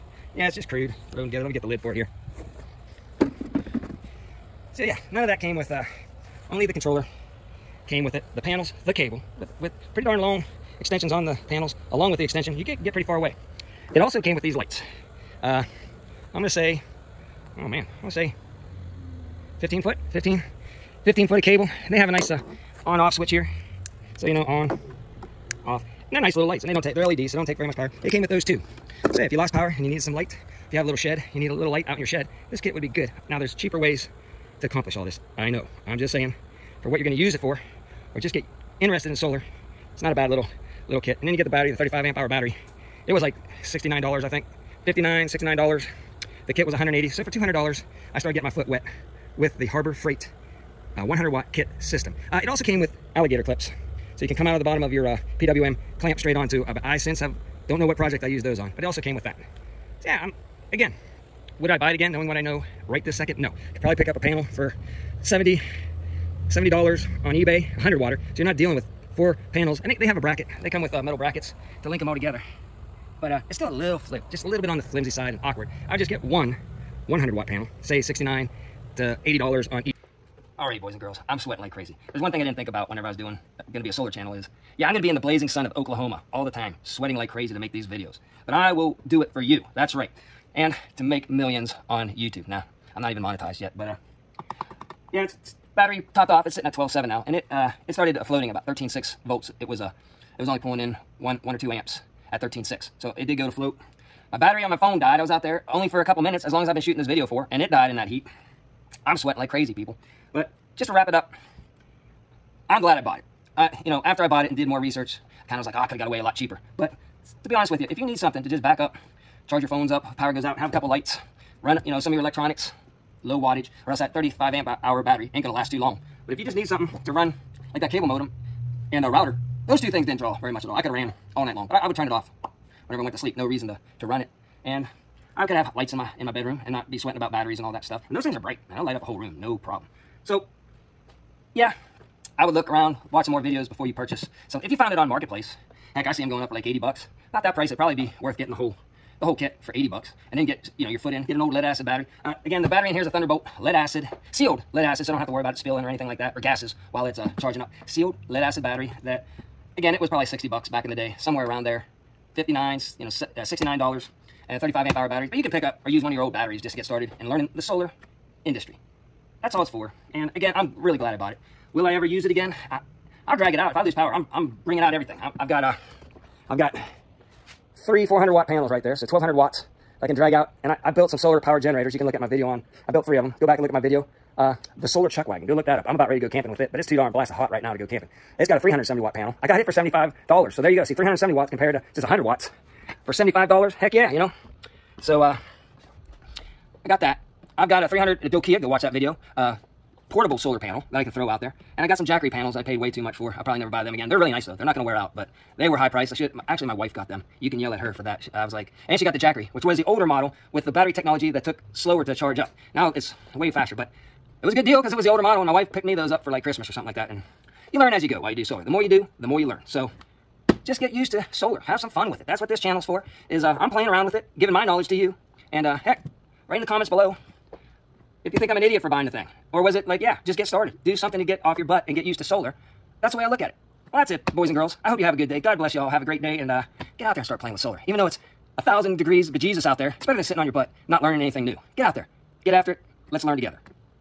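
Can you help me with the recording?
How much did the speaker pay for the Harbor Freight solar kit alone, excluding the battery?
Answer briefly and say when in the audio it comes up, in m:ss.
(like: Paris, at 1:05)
$180, at 0:46.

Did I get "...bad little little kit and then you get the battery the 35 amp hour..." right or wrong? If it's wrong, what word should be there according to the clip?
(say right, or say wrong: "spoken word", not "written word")
right.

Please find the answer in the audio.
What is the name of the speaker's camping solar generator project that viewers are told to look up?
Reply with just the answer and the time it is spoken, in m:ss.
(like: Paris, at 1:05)
solar chuck wagon, at 3:04.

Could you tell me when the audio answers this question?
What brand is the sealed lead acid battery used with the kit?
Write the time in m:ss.
2:33.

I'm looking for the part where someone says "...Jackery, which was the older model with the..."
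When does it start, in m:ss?
3:29.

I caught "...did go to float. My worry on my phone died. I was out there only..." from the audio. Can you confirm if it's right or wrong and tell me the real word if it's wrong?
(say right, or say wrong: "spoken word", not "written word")
wrong: "battery", not "worry".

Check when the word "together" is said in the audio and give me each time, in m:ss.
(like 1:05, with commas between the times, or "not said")
0:01, 1:12, 4:03.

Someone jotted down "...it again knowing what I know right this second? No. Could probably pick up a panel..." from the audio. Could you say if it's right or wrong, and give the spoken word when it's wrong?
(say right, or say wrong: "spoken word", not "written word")
right.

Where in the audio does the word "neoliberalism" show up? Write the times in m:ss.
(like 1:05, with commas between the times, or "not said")
not said.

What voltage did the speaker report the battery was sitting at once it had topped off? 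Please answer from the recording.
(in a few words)
12.7.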